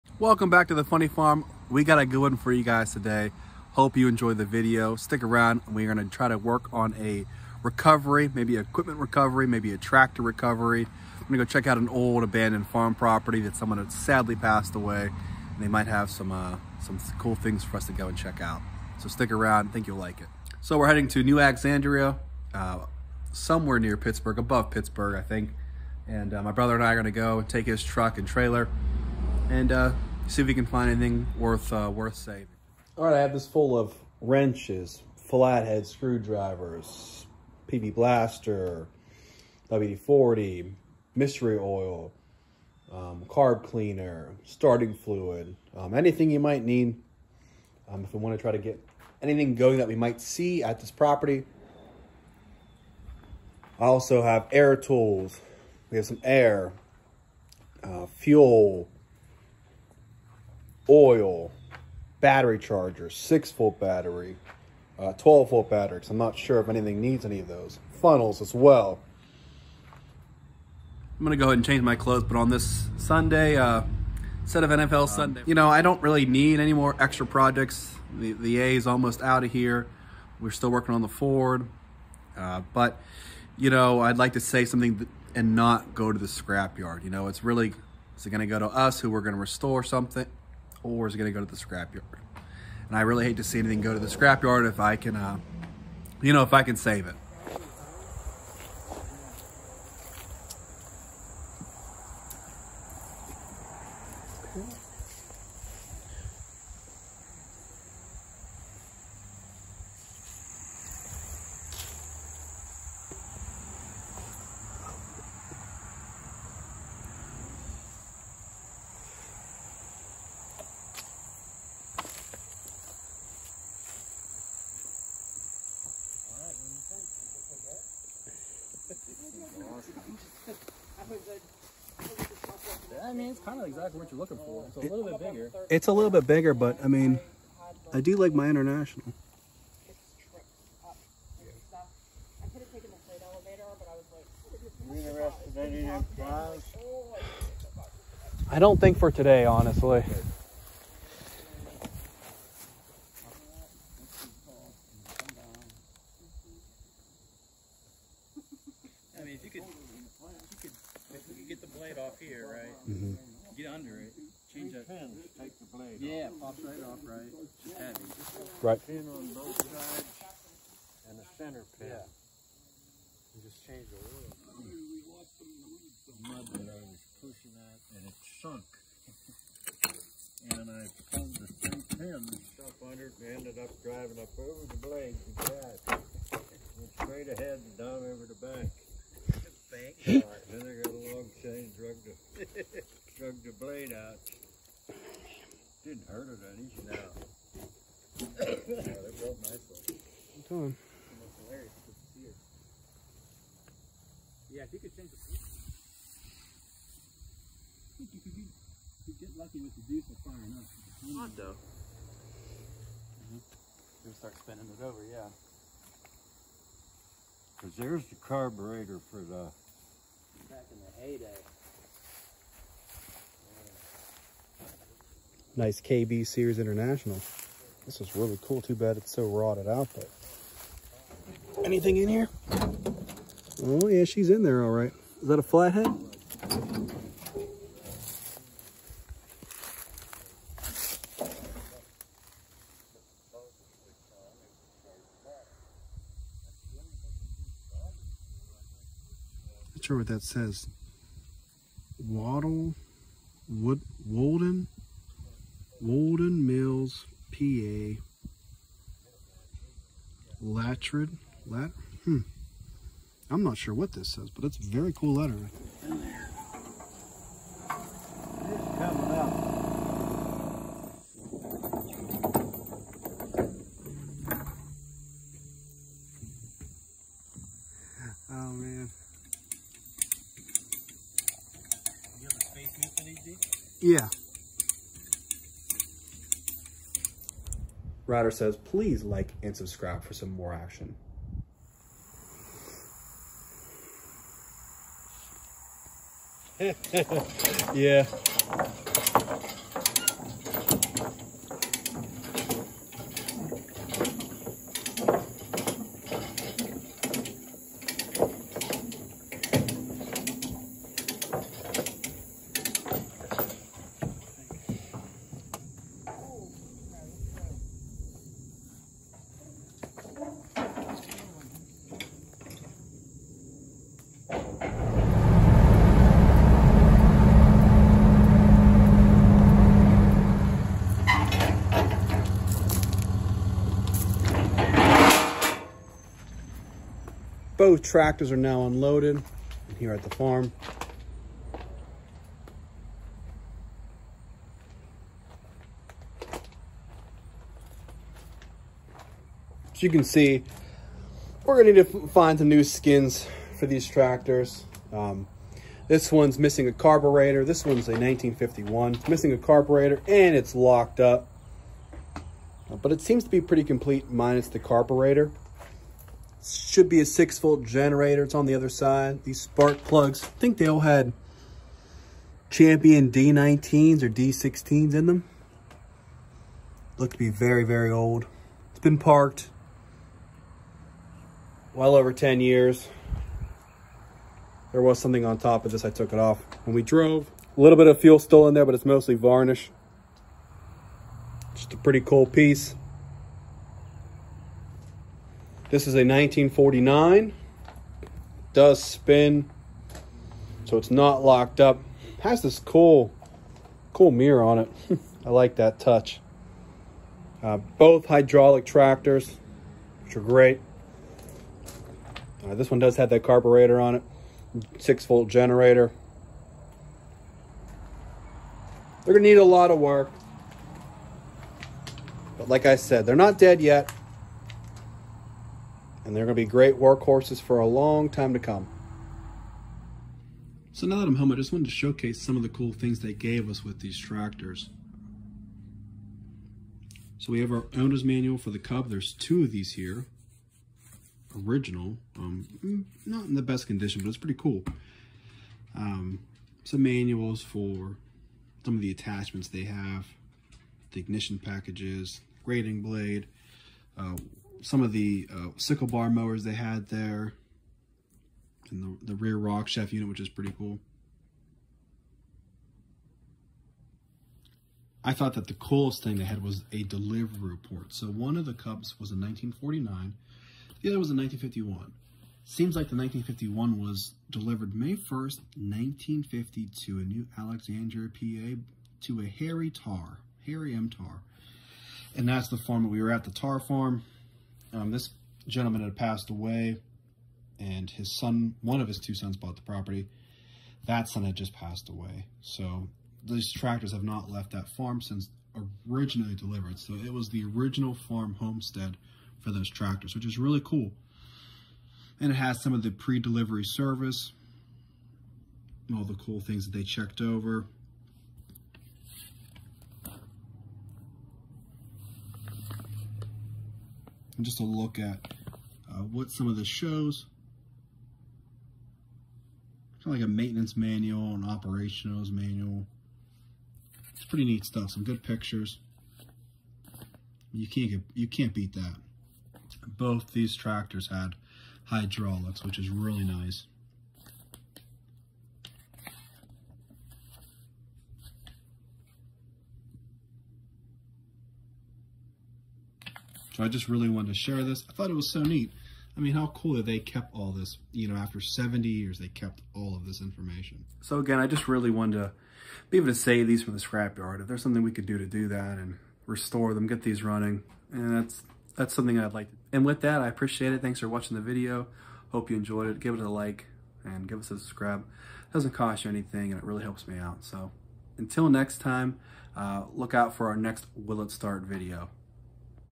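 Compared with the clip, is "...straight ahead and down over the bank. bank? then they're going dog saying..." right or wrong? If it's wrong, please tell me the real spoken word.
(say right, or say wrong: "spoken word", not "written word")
right.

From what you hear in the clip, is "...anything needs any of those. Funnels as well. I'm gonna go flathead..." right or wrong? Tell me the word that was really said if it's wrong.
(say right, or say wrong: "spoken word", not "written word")
wrong: "ahead", not "flathead".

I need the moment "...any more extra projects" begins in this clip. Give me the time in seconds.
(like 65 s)
76 s.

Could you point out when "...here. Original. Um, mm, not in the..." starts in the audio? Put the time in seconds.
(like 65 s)
439 s.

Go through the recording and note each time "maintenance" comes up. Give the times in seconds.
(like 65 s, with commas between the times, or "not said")
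520 s.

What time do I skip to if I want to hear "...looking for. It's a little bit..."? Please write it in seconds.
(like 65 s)
134 s.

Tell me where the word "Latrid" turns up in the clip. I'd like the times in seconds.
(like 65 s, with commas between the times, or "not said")
260 s.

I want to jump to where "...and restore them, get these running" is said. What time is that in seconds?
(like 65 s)
555 s.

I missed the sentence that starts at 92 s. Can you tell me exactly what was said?
And I really hate to see anything go to the scrapyard if I can, uh, you know, if I can save it.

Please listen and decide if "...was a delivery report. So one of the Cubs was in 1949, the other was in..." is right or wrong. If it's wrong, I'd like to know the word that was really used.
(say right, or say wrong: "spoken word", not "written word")
right.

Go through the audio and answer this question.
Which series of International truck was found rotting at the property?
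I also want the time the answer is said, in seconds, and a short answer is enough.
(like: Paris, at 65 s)
KB Series, at 225 s.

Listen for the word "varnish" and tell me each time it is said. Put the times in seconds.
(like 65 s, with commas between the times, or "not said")
389 s.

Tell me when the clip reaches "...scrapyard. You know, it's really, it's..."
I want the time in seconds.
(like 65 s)
86 s.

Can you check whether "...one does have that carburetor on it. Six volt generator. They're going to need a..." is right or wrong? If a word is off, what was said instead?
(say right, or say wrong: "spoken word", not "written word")
right.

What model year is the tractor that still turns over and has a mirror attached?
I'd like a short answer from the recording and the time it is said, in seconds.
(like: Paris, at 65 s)
1949, at 395 s.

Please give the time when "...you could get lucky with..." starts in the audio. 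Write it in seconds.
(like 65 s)
208 s.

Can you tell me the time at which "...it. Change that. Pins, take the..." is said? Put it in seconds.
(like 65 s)
164 s.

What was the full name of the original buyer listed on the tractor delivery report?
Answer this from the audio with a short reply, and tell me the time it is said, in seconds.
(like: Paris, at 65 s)
Harry M. Tar, at 480 s.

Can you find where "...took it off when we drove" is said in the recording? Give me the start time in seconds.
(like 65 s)
385 s.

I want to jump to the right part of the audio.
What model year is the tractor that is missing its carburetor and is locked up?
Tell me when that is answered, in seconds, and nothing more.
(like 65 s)
357 s.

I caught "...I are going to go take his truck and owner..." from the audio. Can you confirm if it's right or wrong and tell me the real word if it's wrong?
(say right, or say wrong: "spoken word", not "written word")
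wrong: "trailer", not "owner".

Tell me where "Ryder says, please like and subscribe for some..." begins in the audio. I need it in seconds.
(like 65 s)
288 s.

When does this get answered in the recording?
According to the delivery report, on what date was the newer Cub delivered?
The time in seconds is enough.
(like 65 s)
474 s.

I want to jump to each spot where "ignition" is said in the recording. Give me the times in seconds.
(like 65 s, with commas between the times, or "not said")
450 s.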